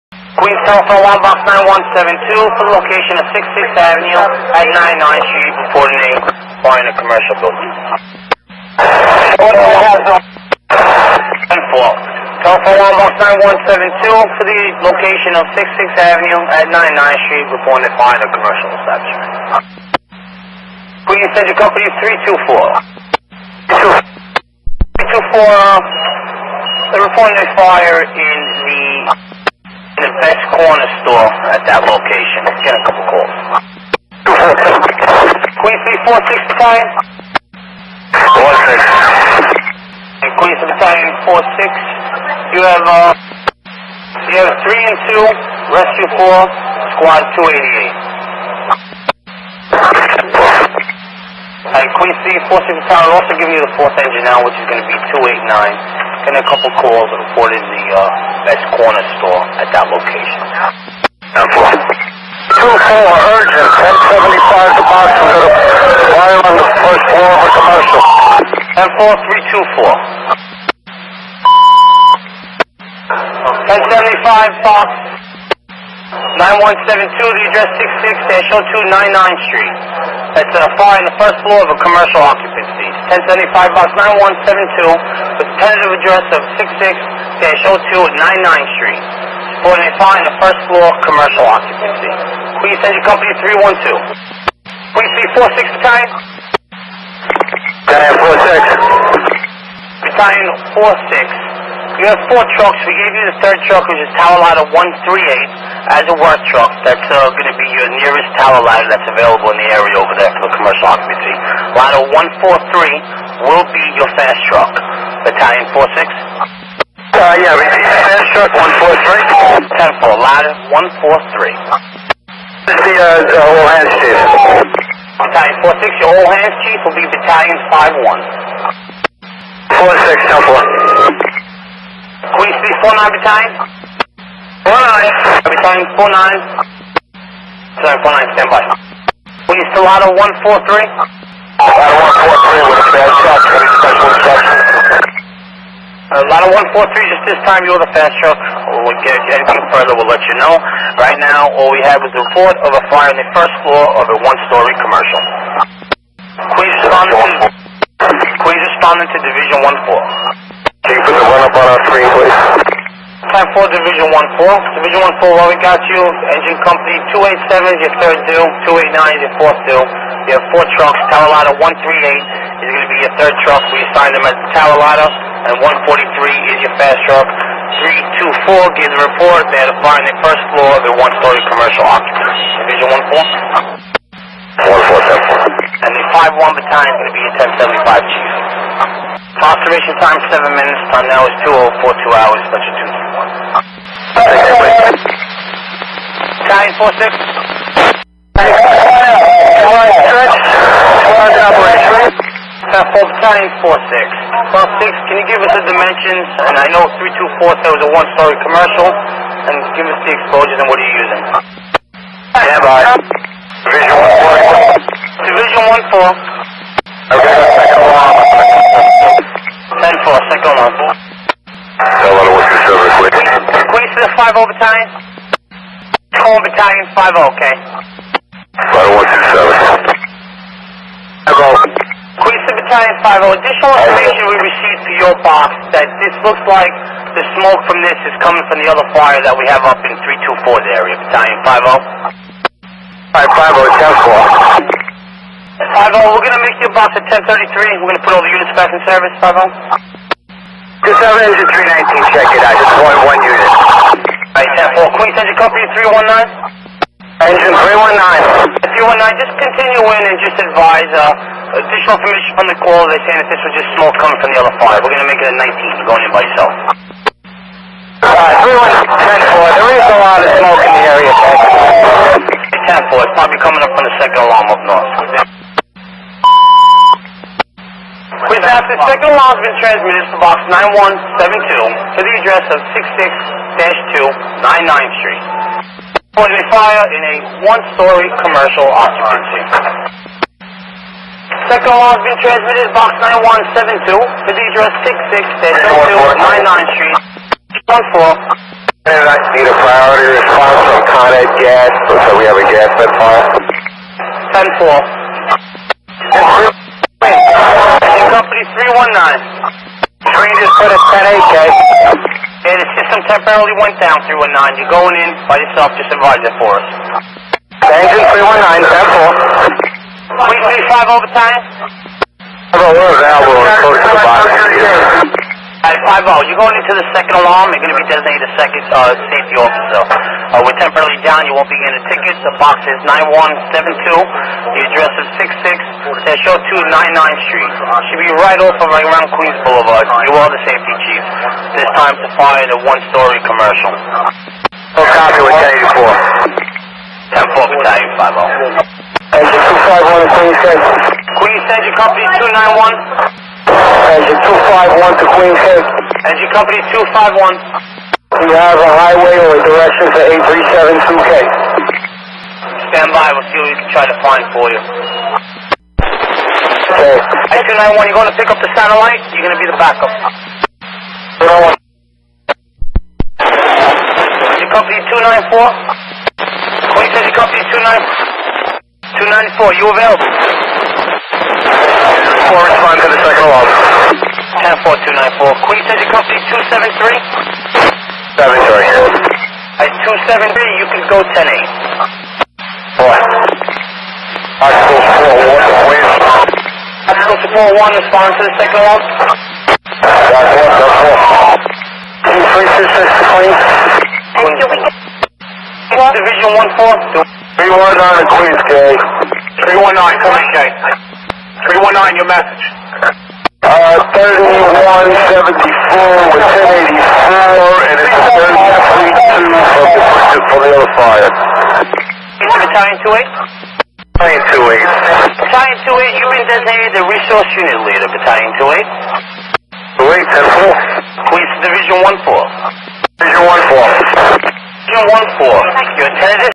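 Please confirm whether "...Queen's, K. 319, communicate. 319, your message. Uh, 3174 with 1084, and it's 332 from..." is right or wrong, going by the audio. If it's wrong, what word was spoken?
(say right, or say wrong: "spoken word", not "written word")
right.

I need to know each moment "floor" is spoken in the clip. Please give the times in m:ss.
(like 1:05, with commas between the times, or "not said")
1:07, 1:21, 1:30, 2:33, 3:00.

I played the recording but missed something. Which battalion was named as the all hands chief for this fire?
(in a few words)
Battalion 51.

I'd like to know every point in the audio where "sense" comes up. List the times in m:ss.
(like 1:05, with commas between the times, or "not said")
not said.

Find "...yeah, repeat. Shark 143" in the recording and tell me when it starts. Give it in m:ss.
1:57.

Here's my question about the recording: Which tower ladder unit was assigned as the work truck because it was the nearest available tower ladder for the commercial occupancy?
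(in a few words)
Tower Ladder 138.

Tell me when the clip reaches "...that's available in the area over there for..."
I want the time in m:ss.
1:48.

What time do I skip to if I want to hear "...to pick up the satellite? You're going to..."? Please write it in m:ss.
6:08.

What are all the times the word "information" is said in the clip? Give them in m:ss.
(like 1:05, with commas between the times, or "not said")
3:53, 4:21.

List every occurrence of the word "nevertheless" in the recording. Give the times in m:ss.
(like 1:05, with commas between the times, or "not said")
not said.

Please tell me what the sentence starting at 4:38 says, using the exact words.
We've that, the second alarm has been transmitted to box 9172 to the address of 66-2 99th Street.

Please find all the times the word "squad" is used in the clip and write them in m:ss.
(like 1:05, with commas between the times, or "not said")
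0:46.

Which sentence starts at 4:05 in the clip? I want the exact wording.
5 we're gonna make your box at 1033.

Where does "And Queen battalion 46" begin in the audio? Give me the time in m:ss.
0:40.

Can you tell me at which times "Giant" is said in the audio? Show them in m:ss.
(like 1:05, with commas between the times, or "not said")
3:52.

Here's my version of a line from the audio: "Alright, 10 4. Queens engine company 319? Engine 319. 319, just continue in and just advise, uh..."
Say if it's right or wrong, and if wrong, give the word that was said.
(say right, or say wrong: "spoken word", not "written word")
right.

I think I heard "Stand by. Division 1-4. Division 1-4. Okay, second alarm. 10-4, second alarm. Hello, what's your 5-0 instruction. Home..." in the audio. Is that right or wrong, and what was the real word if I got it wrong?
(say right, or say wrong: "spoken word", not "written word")
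wrong: "battalion", not "instruction".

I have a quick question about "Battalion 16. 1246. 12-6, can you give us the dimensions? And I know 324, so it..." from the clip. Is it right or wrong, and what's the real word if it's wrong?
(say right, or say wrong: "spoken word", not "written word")
wrong: "46", not "16".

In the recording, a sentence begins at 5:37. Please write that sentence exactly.
Should be right off of right around Queens Boulevard.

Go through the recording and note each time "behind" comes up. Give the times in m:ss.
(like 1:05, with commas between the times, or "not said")
0:06, 0:18.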